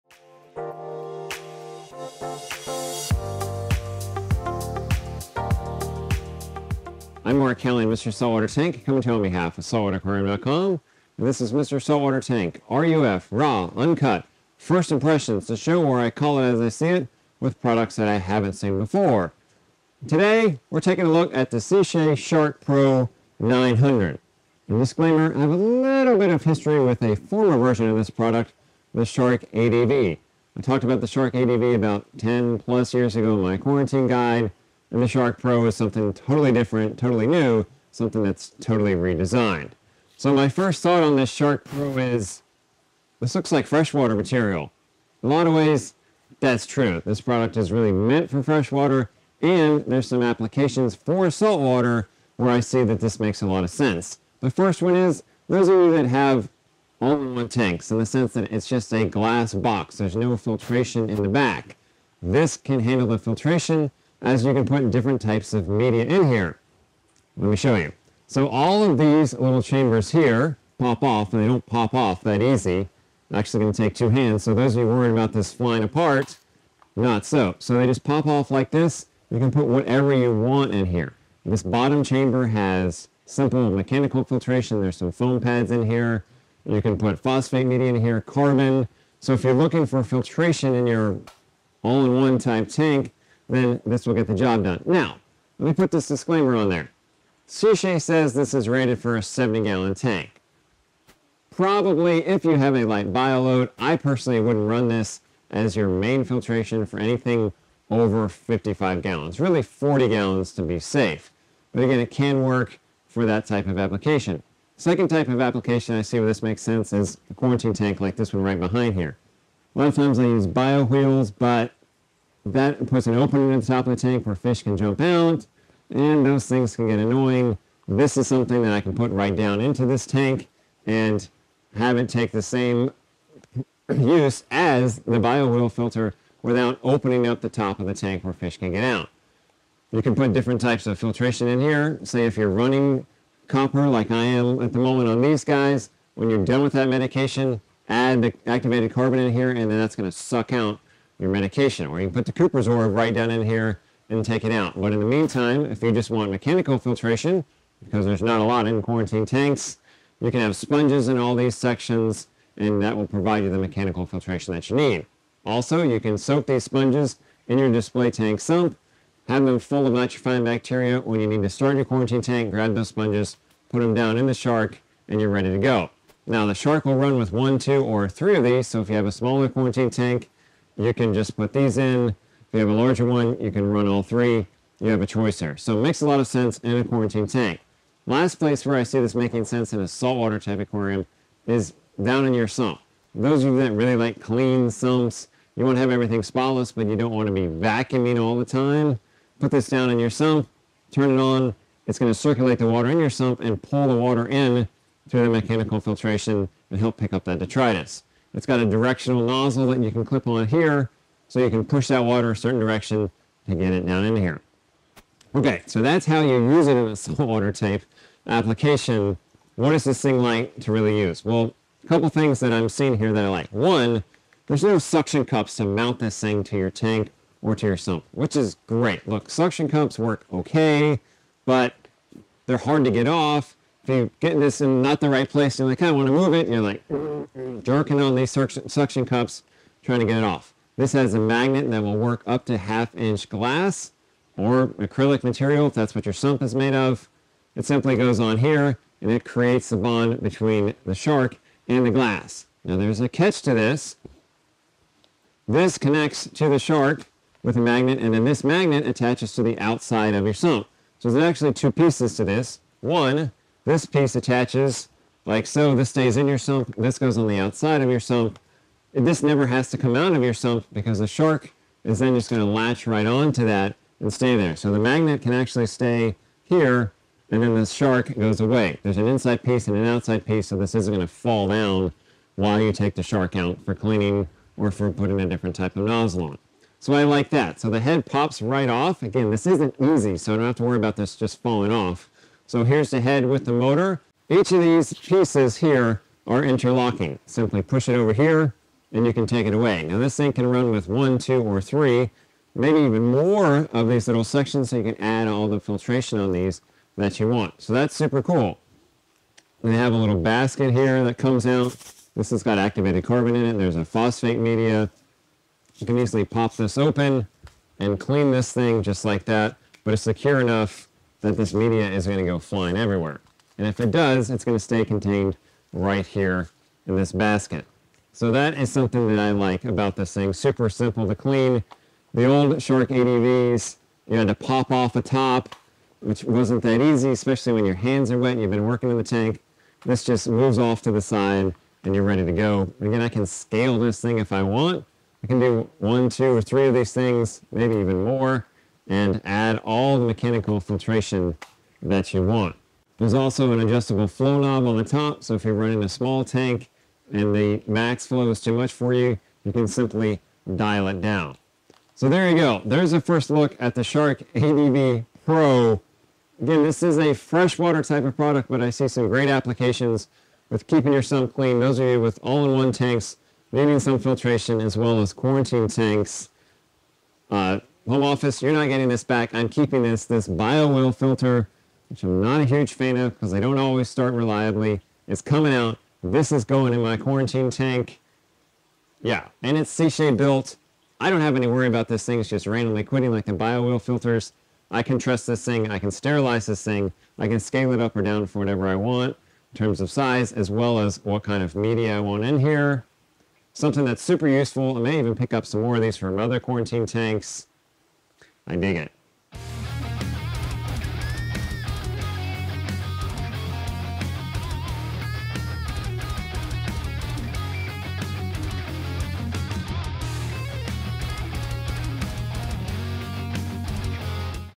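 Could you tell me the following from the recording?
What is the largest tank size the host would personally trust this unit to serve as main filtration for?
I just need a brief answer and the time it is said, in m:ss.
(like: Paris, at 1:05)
55 gallons, at 1:48.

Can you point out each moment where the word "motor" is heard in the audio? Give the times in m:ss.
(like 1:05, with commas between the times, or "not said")
4:53.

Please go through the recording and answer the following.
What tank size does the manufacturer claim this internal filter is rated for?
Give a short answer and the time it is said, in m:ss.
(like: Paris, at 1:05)
70 gallons, at 1:39.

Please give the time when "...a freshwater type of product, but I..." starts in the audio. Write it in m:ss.
6:06.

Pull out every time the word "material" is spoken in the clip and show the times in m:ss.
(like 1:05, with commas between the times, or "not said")
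0:44, 4:05.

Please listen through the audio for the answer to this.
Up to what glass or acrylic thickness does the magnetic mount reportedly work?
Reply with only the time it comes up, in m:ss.
4:02.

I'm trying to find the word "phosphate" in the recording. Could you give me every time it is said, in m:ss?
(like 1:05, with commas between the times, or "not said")
1:27, 5:13.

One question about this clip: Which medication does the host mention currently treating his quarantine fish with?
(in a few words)
copper.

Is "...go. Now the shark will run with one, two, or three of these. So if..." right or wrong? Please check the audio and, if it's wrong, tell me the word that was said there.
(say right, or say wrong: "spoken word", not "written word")
right.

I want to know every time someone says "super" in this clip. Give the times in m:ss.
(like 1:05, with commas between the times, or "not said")
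5:07, 5:30, 6:44.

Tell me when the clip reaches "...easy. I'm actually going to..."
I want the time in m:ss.
1:12.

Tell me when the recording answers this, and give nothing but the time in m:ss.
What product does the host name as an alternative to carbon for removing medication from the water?
2:32.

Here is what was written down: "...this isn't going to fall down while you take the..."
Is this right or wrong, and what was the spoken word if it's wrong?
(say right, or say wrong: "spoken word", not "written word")
right.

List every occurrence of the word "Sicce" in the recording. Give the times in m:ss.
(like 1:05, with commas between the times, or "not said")
0:21, 1:37, 6:29.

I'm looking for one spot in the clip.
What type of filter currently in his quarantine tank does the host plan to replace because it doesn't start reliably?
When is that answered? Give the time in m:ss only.
6:20.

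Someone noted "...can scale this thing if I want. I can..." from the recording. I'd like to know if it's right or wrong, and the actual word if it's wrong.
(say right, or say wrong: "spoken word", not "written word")
right.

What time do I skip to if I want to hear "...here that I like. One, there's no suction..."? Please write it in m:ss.
3:42.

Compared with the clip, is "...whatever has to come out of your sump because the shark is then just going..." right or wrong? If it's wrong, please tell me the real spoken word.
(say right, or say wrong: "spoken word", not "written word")
wrong: "never", not "whatever".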